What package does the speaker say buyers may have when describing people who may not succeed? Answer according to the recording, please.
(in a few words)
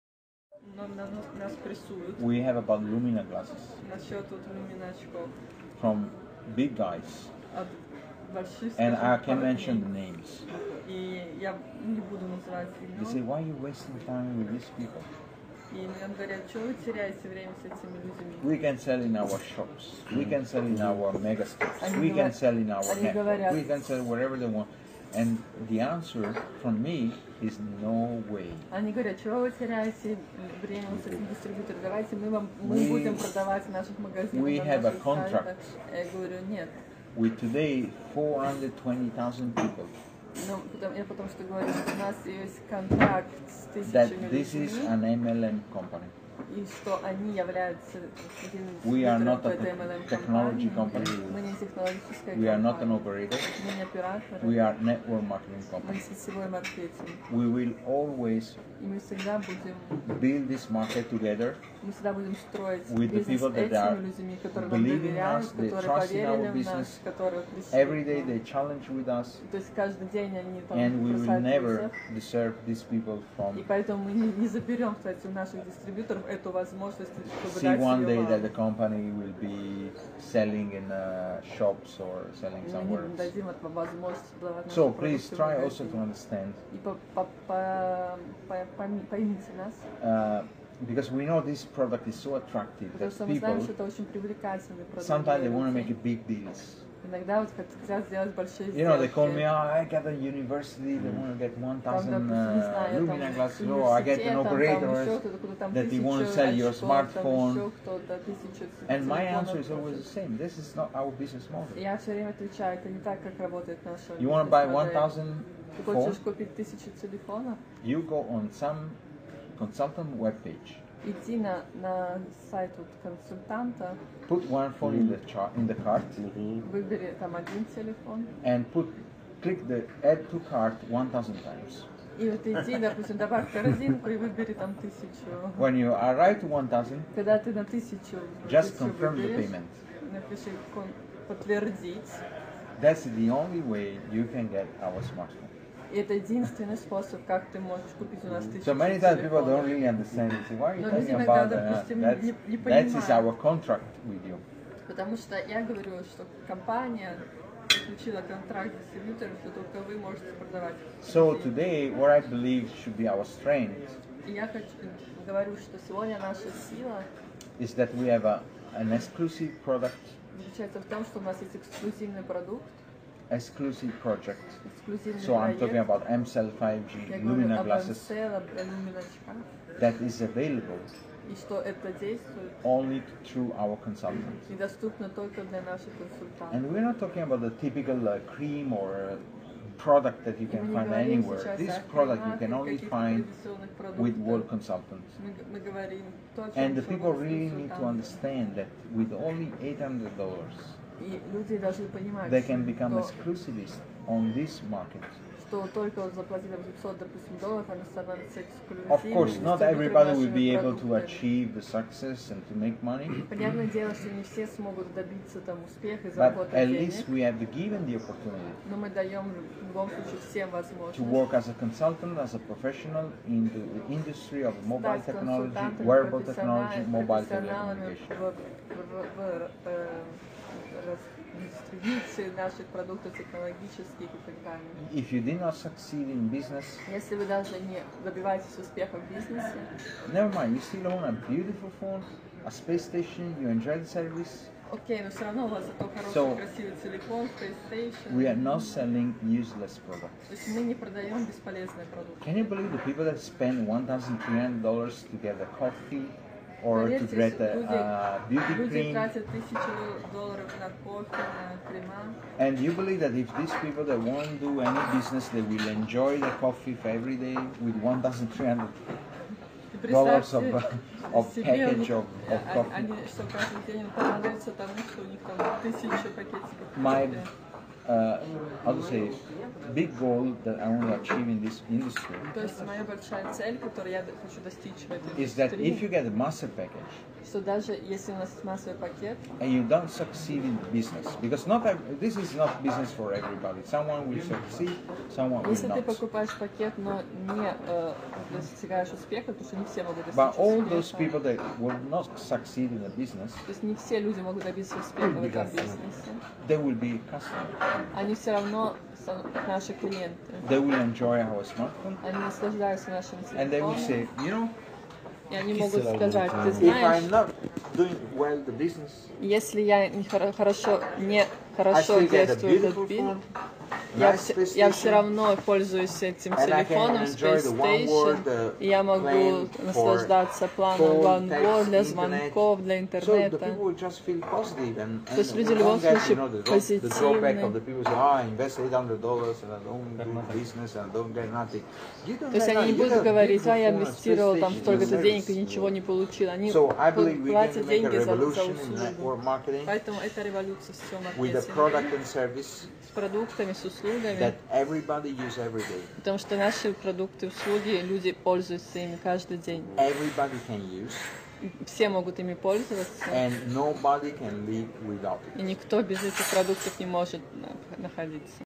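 master package.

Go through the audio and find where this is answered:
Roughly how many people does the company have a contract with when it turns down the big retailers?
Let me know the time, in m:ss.
0:38.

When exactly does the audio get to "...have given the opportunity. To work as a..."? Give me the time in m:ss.
3:37.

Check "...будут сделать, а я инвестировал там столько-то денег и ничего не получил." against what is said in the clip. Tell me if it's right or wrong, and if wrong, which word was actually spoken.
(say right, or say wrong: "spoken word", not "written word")
wrong: "говорить", not "сделать".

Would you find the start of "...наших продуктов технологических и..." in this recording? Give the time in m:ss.
3:52.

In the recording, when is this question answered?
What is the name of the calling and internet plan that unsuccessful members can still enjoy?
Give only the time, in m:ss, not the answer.
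5:31.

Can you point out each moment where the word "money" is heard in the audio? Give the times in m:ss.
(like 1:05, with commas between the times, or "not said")
3:32.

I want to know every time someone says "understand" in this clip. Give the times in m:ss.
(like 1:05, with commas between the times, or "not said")
1:25, 2:29, 3:17.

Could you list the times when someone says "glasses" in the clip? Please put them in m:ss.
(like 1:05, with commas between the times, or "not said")
0:03, 1:43, 2:57.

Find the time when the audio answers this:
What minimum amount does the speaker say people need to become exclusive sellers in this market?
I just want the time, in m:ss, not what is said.
3:19.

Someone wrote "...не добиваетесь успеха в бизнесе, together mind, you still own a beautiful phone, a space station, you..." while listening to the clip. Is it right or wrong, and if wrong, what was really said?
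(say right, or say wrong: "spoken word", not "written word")
wrong: "never", not "together".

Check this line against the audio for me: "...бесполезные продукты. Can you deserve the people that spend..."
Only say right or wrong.
wrong.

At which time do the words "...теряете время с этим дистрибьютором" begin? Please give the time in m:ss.
0:29.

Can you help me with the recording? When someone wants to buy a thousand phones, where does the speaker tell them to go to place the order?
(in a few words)
consultant webpage.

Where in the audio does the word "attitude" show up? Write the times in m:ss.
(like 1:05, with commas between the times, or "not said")
not said.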